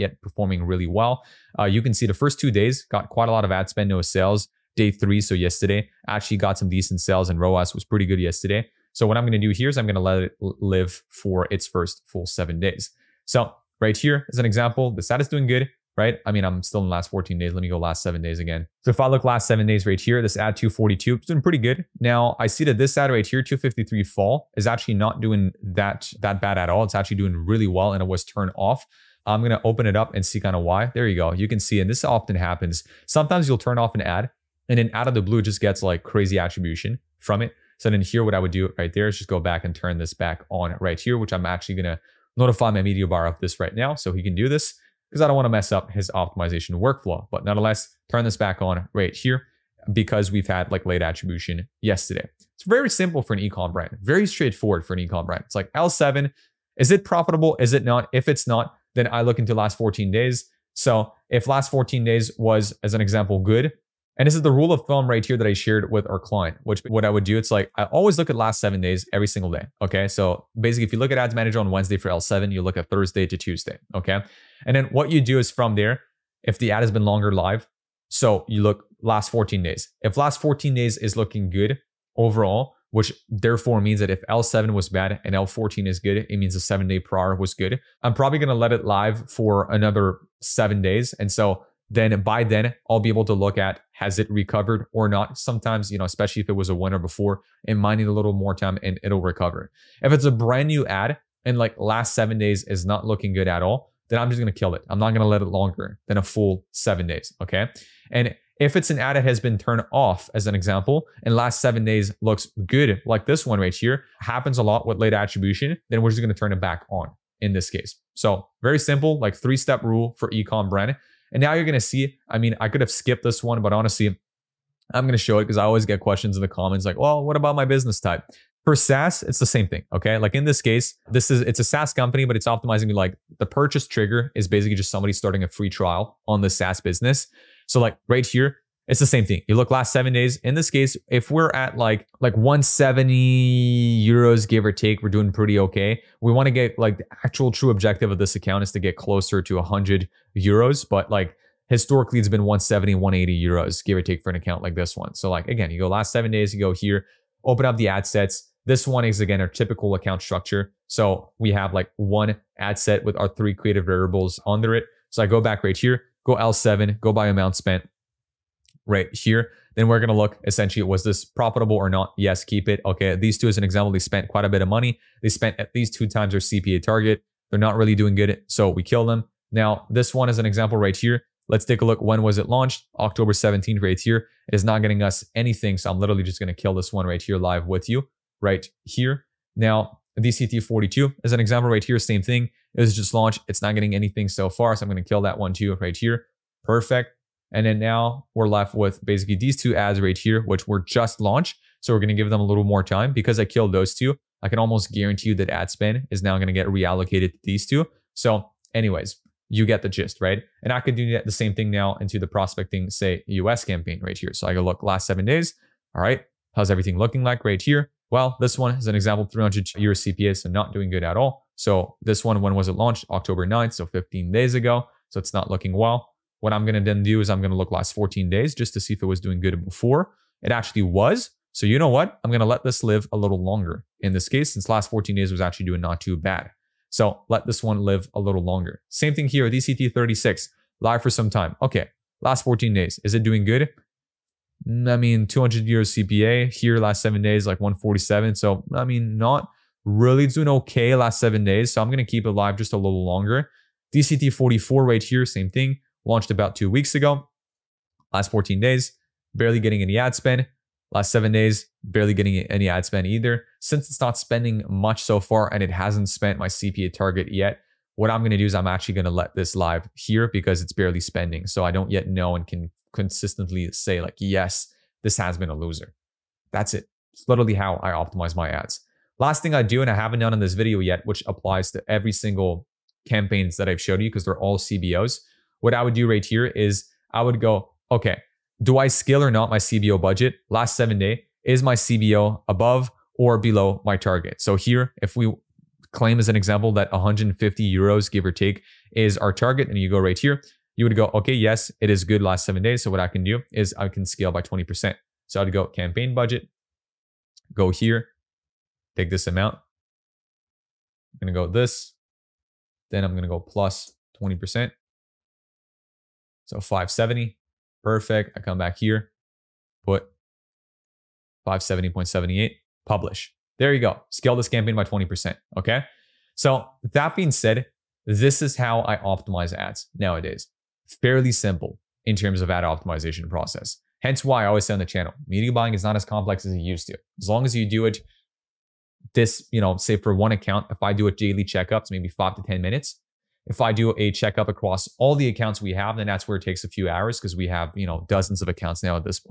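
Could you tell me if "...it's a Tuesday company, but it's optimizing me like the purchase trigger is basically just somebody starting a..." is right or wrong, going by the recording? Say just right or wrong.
wrong.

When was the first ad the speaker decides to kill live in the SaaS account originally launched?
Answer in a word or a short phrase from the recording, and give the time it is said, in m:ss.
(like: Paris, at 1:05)
October 17th, at 3:02.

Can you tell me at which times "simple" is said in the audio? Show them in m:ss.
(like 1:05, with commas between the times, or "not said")
0:52, 1:58, 5:31.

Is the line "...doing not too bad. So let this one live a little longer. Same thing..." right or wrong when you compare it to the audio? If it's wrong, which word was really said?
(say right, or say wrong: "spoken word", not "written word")
right.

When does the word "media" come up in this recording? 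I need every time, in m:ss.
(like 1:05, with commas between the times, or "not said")
0:42, 5:35.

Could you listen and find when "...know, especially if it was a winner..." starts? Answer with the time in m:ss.
1:35.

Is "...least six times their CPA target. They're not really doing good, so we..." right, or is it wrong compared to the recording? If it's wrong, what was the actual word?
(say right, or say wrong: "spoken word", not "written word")
wrong: "two", not "six".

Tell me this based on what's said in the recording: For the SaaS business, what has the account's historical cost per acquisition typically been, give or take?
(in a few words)
170, 180 euros.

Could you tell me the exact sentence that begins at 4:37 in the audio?
It's literally how I optimize my ads.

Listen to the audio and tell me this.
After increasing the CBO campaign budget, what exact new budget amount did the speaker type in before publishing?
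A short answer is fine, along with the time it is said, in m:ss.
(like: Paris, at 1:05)
570.78, at 5:21.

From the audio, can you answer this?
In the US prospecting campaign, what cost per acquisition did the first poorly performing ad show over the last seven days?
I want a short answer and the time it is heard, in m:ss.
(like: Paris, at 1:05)
300 euros, at 3:39.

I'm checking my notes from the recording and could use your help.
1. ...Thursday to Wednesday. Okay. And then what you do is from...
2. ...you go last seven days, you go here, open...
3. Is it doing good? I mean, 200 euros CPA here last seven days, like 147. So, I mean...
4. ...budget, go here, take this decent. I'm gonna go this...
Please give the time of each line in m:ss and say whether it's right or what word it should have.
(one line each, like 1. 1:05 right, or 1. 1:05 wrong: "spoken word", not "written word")
1. 1:12 wrong: "Tuesday", not "Wednesday"
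2. 2:35 right
3. 4:03 right
4. 5:06 wrong: "amount", not "decent".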